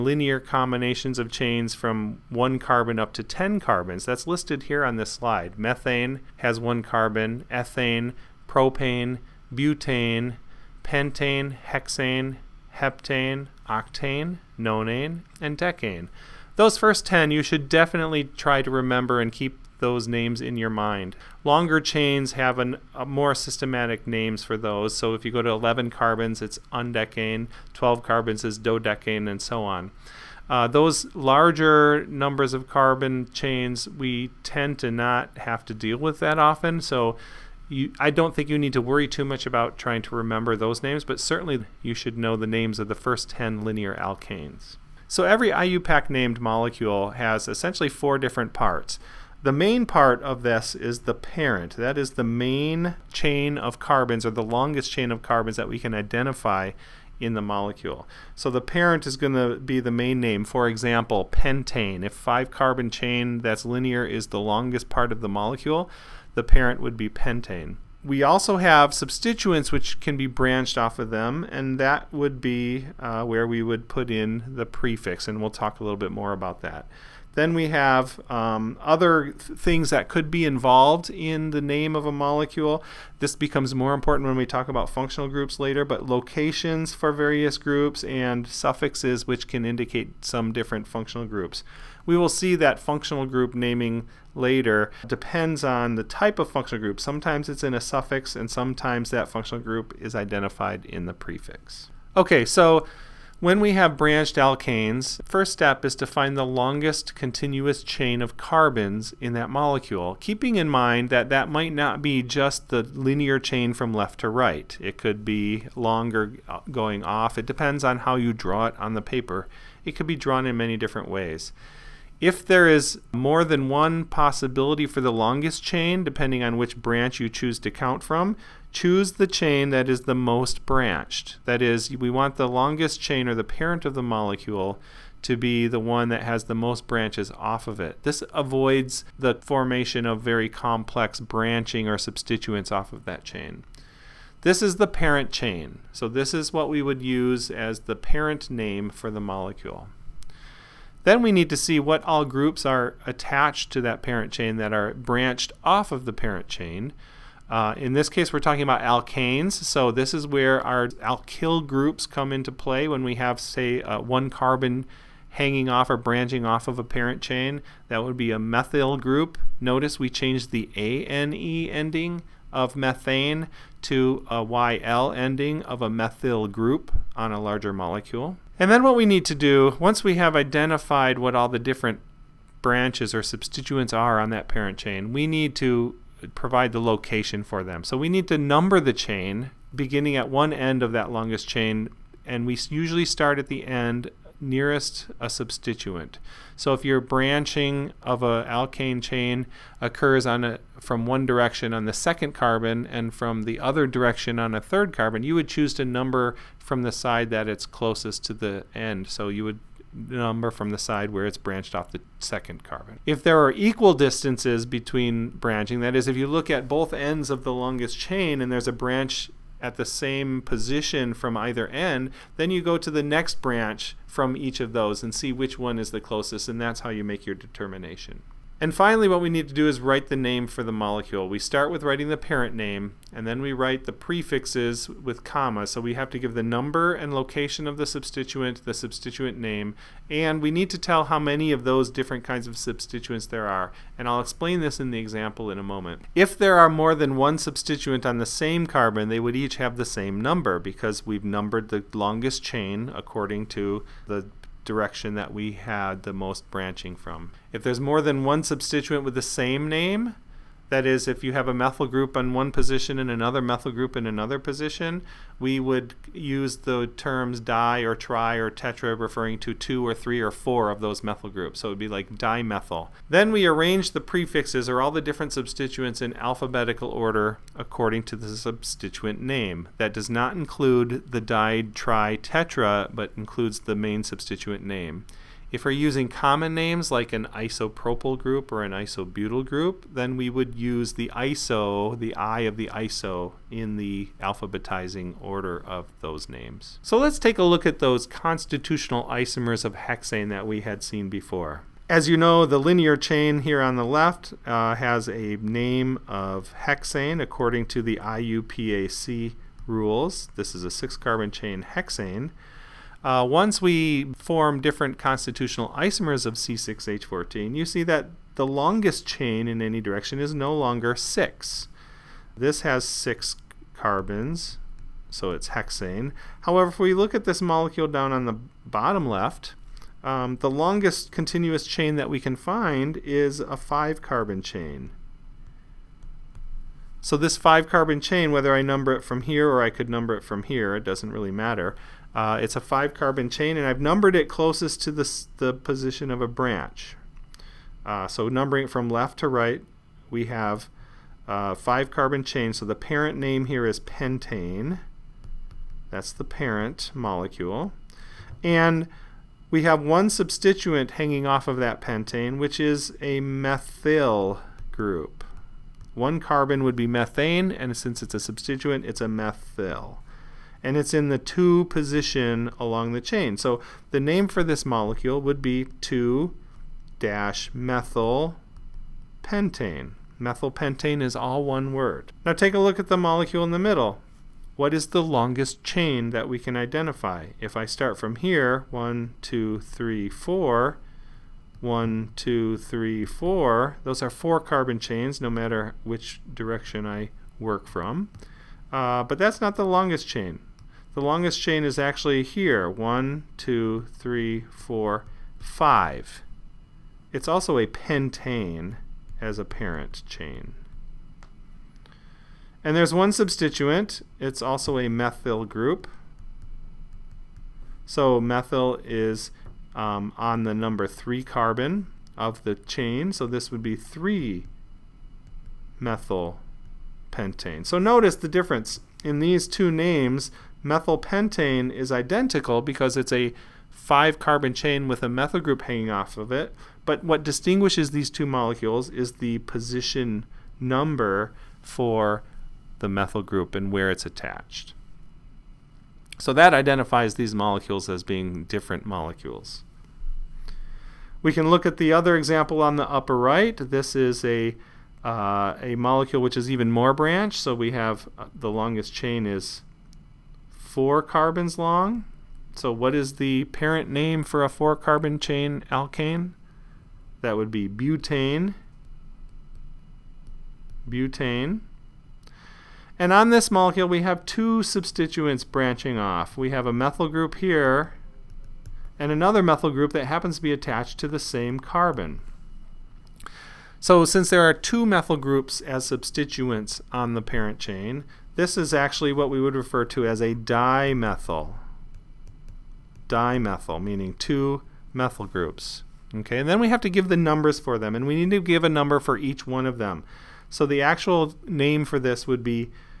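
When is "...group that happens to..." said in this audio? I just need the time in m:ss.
7:59.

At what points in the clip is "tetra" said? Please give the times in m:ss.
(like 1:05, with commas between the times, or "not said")
4:28, 4:42.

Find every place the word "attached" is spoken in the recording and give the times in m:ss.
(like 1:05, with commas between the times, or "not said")
2:33, 7:24, 8:00.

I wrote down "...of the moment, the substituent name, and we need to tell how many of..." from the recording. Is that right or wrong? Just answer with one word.
wrong.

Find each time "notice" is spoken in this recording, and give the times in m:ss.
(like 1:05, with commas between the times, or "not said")
2:49, 7:07.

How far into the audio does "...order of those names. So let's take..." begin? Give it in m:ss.
4:55.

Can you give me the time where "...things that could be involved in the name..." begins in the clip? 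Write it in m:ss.
1:19.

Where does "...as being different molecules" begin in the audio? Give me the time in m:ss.
7:27.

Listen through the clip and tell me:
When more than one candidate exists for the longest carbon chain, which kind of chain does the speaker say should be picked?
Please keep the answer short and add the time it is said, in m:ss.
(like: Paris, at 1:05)
the most branched, at 2:10.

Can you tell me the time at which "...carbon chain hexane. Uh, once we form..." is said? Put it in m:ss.
5:10.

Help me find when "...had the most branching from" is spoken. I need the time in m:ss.
4:15.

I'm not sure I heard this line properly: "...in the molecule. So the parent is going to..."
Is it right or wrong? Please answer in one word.
right.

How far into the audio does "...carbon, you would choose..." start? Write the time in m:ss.
3:24.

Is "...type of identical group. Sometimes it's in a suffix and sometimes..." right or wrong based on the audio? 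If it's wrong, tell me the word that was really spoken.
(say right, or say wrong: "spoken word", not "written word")
wrong: "functional", not "identical".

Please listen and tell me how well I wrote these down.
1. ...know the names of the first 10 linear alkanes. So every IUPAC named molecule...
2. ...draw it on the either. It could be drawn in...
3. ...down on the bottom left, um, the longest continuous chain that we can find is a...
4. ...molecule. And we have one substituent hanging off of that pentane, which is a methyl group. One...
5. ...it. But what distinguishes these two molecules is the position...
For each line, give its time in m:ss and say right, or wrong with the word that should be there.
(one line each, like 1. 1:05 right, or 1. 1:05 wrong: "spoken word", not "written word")
1. 0:42 right
2. 1:58 wrong: "paper", not "either"
3. 5:27 right
4. 5:56 right
5. 7:16 right.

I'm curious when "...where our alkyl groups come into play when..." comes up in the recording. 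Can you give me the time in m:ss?
2:40.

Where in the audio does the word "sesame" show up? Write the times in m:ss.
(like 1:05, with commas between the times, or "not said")
not said.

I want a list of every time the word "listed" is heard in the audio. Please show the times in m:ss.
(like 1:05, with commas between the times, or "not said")
0:04.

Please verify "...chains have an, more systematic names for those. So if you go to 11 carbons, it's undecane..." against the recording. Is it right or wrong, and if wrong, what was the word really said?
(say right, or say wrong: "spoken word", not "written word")
right.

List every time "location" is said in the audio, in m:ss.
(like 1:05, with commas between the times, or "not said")
1:26, 3:06, 3:57.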